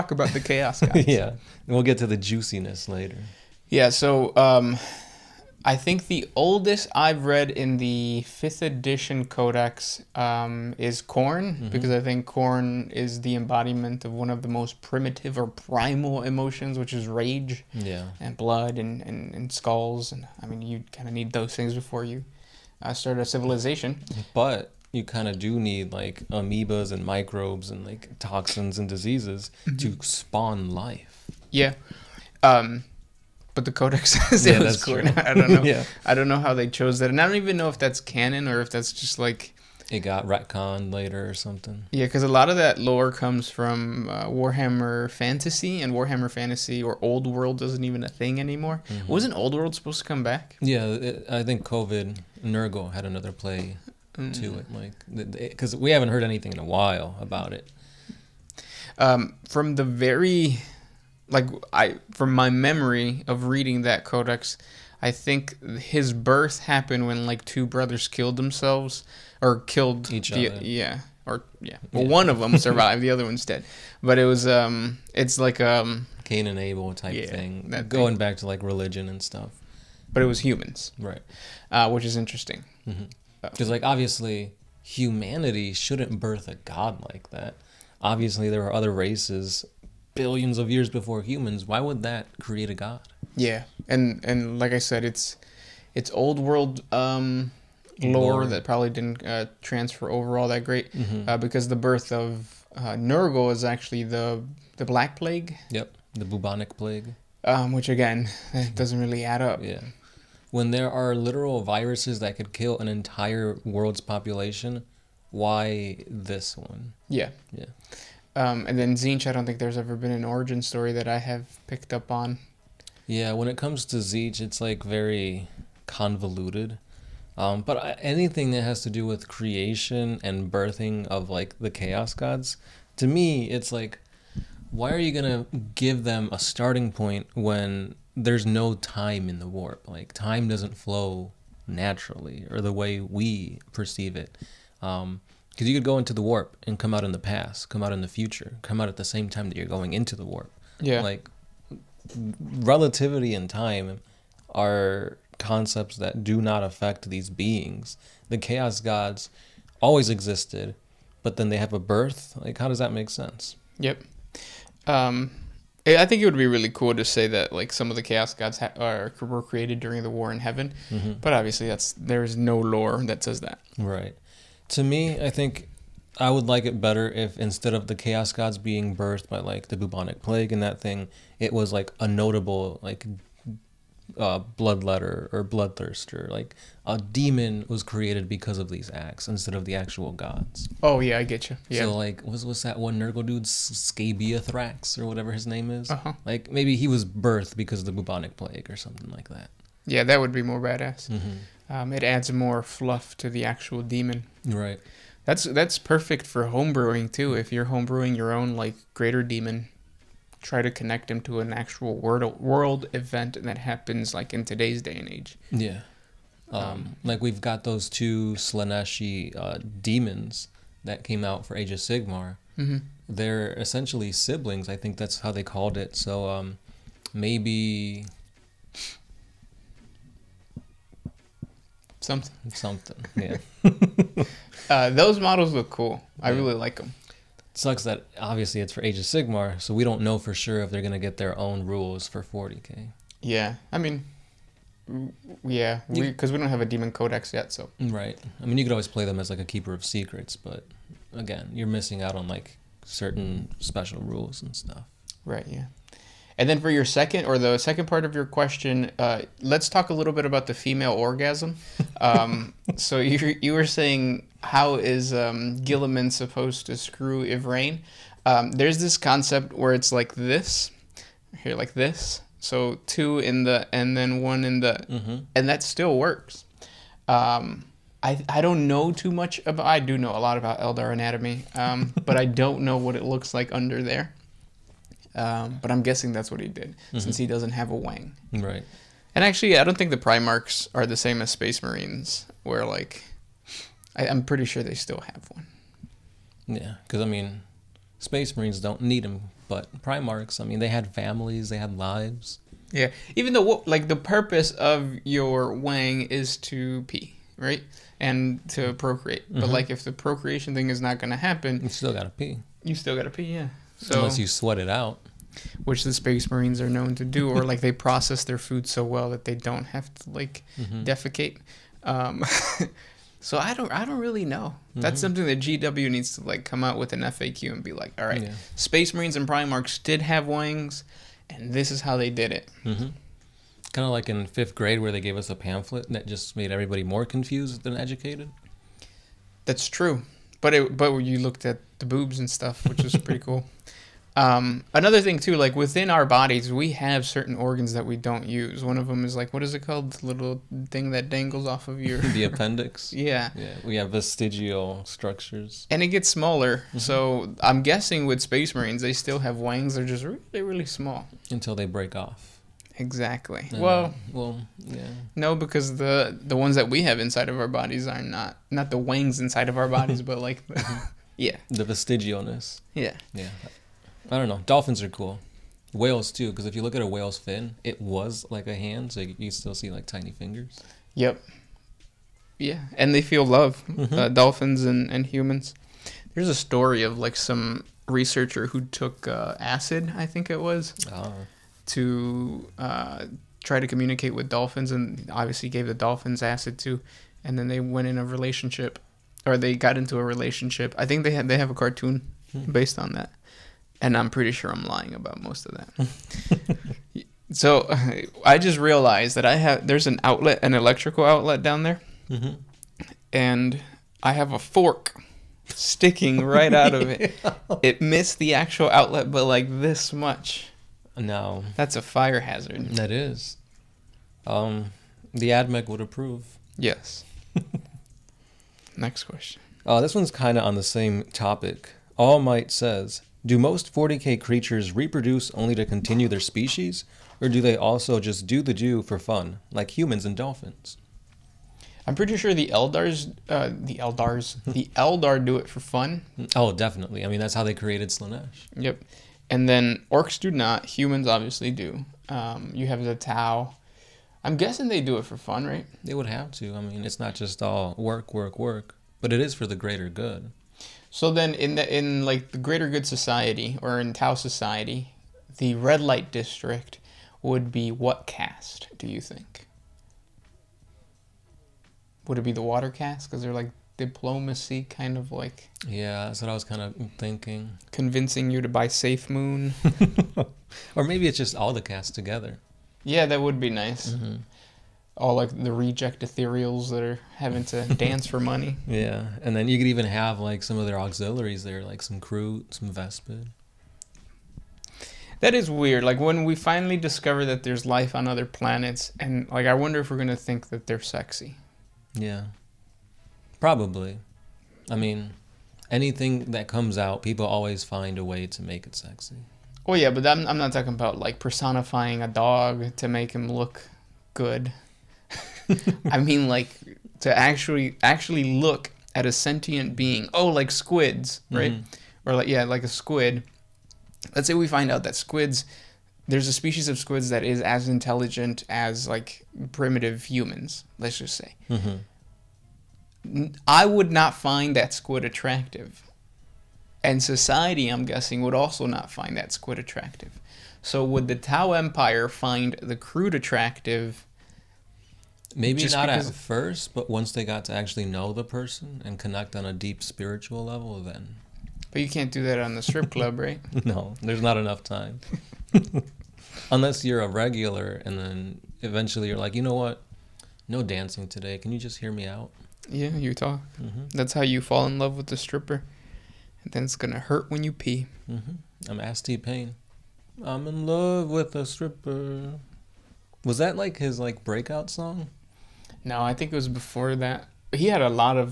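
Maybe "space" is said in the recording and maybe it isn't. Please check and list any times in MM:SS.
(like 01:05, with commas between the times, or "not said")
04:51, 04:57, 05:15, 05:28, 05:58.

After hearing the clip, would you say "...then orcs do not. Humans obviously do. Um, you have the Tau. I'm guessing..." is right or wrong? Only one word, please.
right.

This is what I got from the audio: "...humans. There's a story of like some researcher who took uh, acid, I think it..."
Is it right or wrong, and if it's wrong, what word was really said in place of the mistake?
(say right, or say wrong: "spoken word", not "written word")
right.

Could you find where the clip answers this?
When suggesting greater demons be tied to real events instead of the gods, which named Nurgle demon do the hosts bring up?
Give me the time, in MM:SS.
03:13.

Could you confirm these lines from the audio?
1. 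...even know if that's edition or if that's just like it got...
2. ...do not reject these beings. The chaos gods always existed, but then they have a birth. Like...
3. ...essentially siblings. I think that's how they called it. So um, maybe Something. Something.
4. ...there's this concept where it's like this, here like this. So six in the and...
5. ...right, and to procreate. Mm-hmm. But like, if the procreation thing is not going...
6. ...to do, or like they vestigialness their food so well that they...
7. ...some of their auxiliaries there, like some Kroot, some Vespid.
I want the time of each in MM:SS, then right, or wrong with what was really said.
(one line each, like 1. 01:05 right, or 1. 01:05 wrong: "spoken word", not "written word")
1. 00:37 wrong: "canon", not "edition"
2. 02:36 wrong: "affect", not "reject"
3. 03:43 right
4. 04:28 wrong: "two", not "six"
5. 05:07 right
6. 05:16 wrong: "process", not "vestigialness"
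7. 08:10 right.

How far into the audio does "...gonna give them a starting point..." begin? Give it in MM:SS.
02:15.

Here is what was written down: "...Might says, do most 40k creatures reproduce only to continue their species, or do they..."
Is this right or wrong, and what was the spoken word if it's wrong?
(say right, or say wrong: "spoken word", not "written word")
right.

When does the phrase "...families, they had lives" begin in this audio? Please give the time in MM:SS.
05:00.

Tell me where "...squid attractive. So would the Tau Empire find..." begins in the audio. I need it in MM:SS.
08:59.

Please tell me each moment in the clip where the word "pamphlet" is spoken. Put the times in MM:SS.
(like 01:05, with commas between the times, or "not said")
05:35.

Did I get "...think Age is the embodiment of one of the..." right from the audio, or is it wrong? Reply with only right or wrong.
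wrong.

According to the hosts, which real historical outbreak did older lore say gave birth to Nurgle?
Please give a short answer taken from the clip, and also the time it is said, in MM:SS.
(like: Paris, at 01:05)
The Black Plague, at 01:44.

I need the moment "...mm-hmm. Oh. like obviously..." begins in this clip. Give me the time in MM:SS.
01:23.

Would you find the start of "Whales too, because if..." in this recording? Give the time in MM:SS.
06:15.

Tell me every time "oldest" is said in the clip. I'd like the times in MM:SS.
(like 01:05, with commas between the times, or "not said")
00:06.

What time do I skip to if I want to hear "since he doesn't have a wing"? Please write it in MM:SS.
04:46.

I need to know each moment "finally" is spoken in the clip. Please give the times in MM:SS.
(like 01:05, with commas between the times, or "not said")
08:16.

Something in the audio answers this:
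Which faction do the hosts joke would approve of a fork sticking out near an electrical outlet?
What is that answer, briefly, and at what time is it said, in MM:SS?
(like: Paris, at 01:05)
The AdMech, at 07:05.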